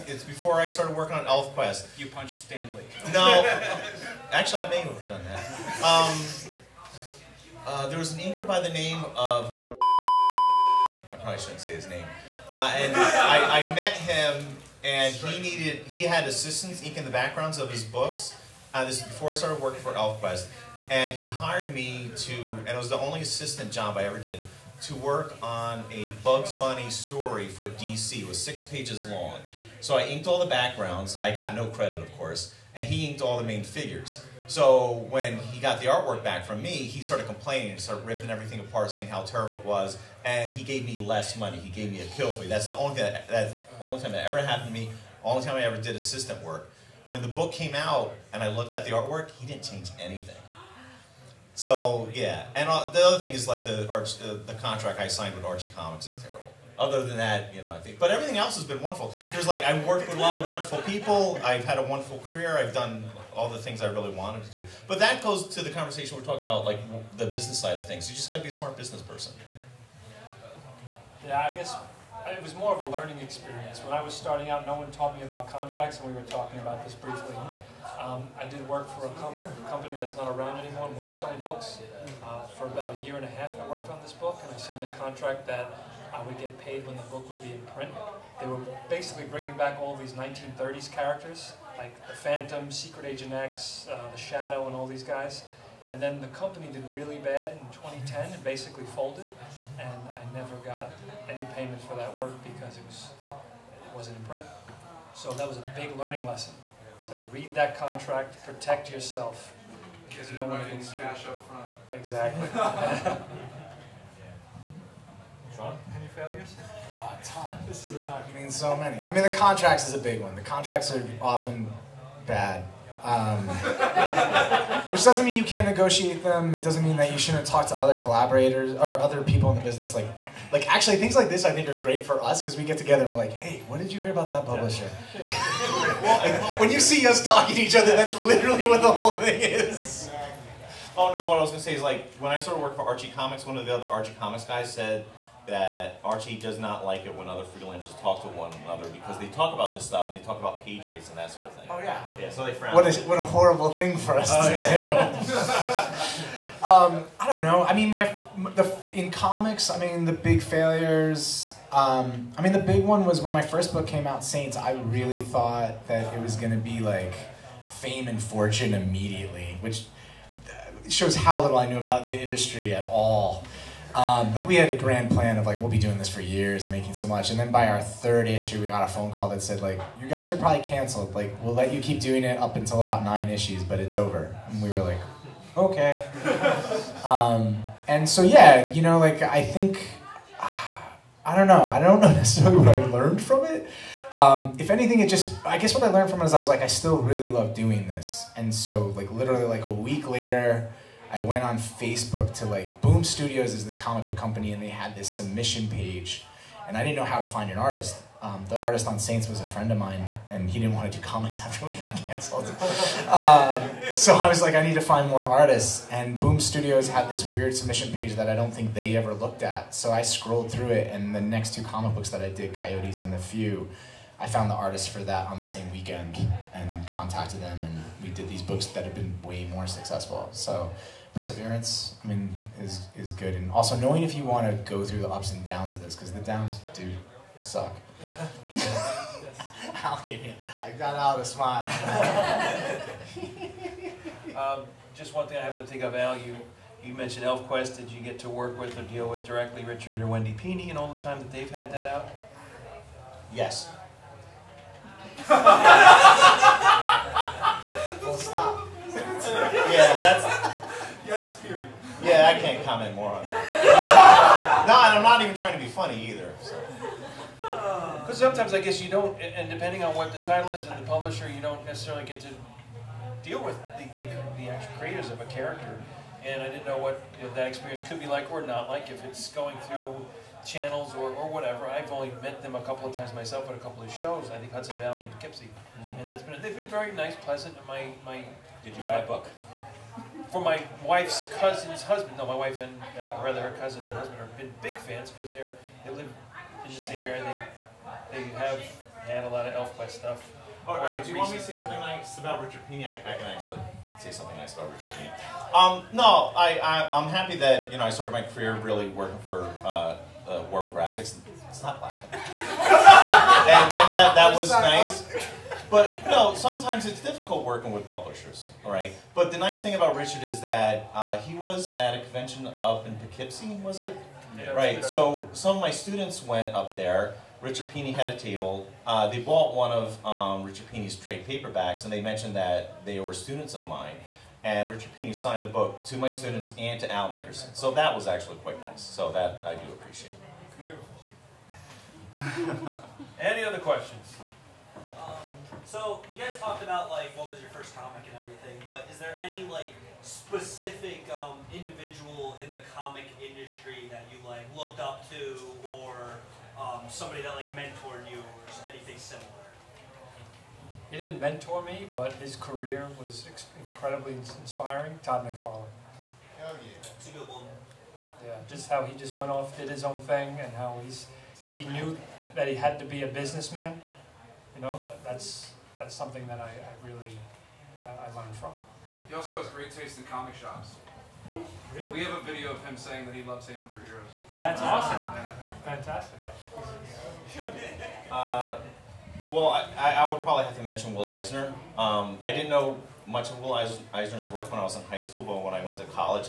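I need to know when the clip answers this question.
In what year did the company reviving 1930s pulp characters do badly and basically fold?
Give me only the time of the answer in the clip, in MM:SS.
01:37.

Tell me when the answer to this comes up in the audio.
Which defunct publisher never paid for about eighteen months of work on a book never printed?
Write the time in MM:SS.
01:20.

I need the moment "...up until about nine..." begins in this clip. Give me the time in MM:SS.
03:02.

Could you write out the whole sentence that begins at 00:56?
Other than that, you know, I think.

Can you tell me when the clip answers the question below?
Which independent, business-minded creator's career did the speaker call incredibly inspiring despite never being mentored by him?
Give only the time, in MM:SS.
06:05.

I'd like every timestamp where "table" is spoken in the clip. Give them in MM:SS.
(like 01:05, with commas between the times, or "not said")
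05:28.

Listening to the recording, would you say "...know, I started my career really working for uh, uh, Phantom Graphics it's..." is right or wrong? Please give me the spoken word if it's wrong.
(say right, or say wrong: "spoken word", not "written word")
wrong: "Warp", not "Phantom".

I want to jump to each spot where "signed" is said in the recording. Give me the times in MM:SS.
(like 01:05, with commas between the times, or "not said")
00:55, 01:24, 05:35.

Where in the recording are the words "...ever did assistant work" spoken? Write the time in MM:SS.
00:45.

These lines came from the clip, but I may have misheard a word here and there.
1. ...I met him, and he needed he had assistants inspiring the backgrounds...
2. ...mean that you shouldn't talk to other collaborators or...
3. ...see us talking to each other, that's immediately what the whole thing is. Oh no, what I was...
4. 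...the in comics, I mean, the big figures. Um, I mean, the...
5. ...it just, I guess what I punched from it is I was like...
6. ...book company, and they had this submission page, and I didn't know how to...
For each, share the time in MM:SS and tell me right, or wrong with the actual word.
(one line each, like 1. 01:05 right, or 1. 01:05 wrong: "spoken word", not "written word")
1. 00:13 wrong: "inking", not "inspiring"
2. 02:06 right
3. 02:16 wrong: "literally", not "immediately"
4. 02:38 wrong: "failures", not "figures"
5. 03:14 wrong: "learned", not "punched"
6. 03:24 right.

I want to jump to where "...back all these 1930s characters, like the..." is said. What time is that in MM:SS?
01:29.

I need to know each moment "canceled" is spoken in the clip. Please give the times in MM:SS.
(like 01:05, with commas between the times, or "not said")
03:00, 03:31.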